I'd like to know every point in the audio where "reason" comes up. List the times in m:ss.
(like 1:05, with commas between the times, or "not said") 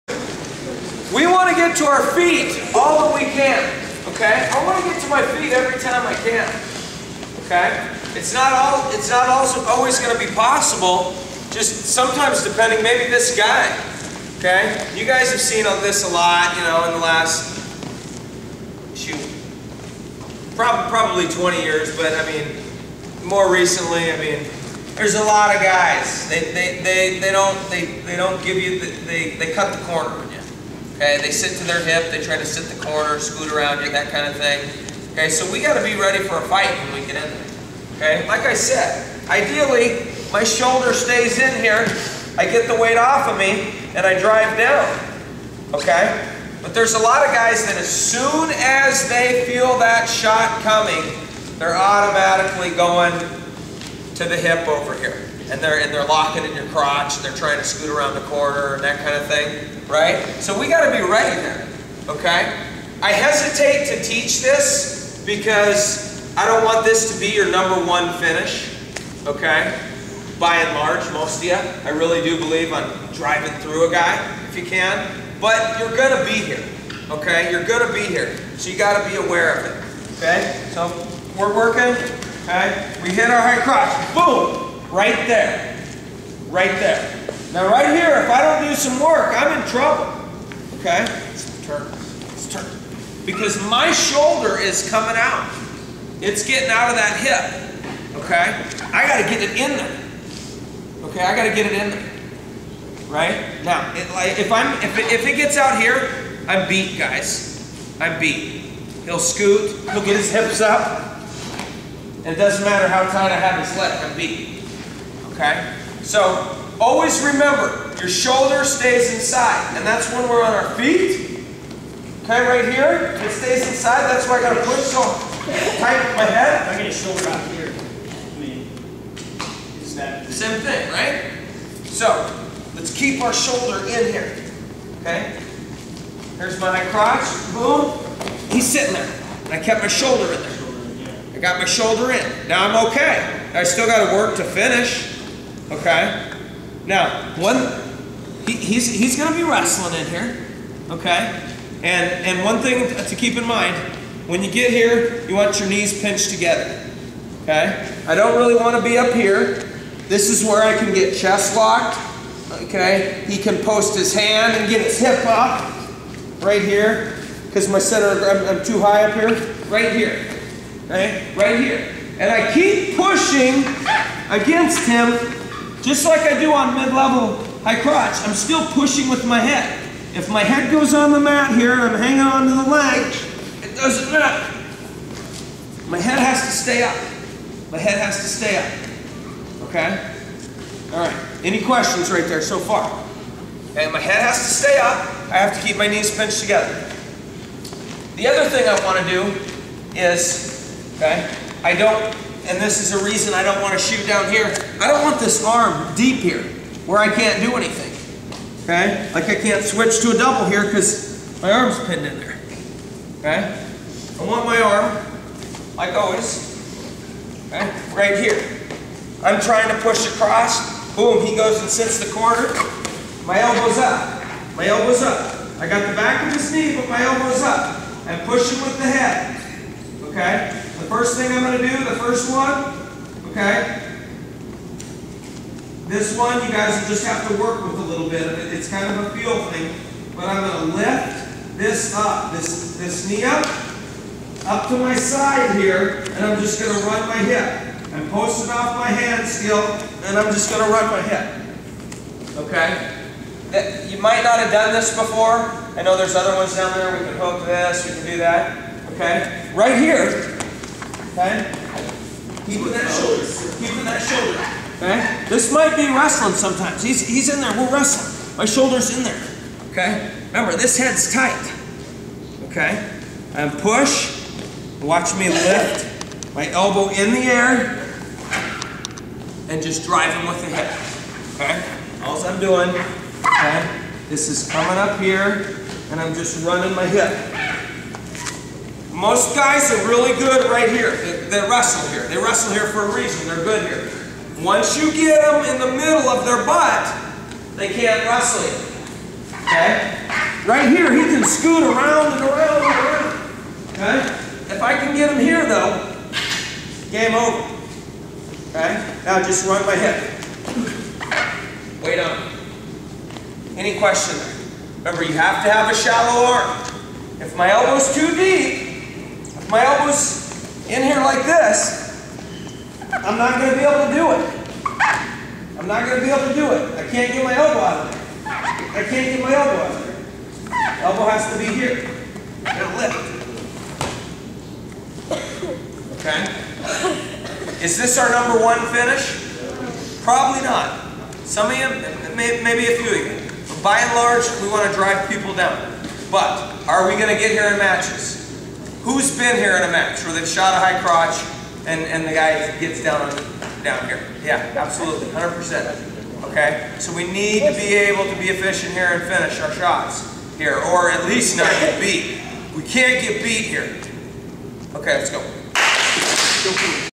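3:23, 4:52.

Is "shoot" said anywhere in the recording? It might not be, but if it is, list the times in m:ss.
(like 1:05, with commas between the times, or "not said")
0:18, 3:23.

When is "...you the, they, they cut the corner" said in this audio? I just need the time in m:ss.
0:28.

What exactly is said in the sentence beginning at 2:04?
That's why I gotta push so tight my head.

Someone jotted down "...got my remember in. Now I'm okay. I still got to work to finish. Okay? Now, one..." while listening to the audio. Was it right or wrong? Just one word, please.
wrong.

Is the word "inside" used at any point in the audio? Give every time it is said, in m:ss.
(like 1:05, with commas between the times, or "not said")
1:59, 2:03.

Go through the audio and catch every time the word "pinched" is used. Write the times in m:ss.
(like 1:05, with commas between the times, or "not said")
2:36, 3:16.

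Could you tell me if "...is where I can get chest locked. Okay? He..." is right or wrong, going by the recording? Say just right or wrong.
right.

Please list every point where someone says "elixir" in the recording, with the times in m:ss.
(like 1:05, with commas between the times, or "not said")
not said.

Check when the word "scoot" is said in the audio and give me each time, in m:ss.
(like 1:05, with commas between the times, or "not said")
0:33, 0:57, 1:49, 5:01.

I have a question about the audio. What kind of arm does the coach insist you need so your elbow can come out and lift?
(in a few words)
a shallow arm.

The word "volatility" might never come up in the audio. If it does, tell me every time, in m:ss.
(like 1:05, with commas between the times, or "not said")
not said.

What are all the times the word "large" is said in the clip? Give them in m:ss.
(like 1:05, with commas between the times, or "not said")
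1:10, 5:43.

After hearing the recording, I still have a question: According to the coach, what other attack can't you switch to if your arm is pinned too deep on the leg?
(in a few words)
a double.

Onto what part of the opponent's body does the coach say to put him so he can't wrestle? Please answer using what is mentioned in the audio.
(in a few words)
middle of their butt.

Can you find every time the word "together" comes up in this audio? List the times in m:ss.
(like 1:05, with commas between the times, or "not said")
2:36, 3:16.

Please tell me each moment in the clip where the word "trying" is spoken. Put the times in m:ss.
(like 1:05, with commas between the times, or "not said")
0:57, 3:39.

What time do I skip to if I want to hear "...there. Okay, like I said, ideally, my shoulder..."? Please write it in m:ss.
0:37.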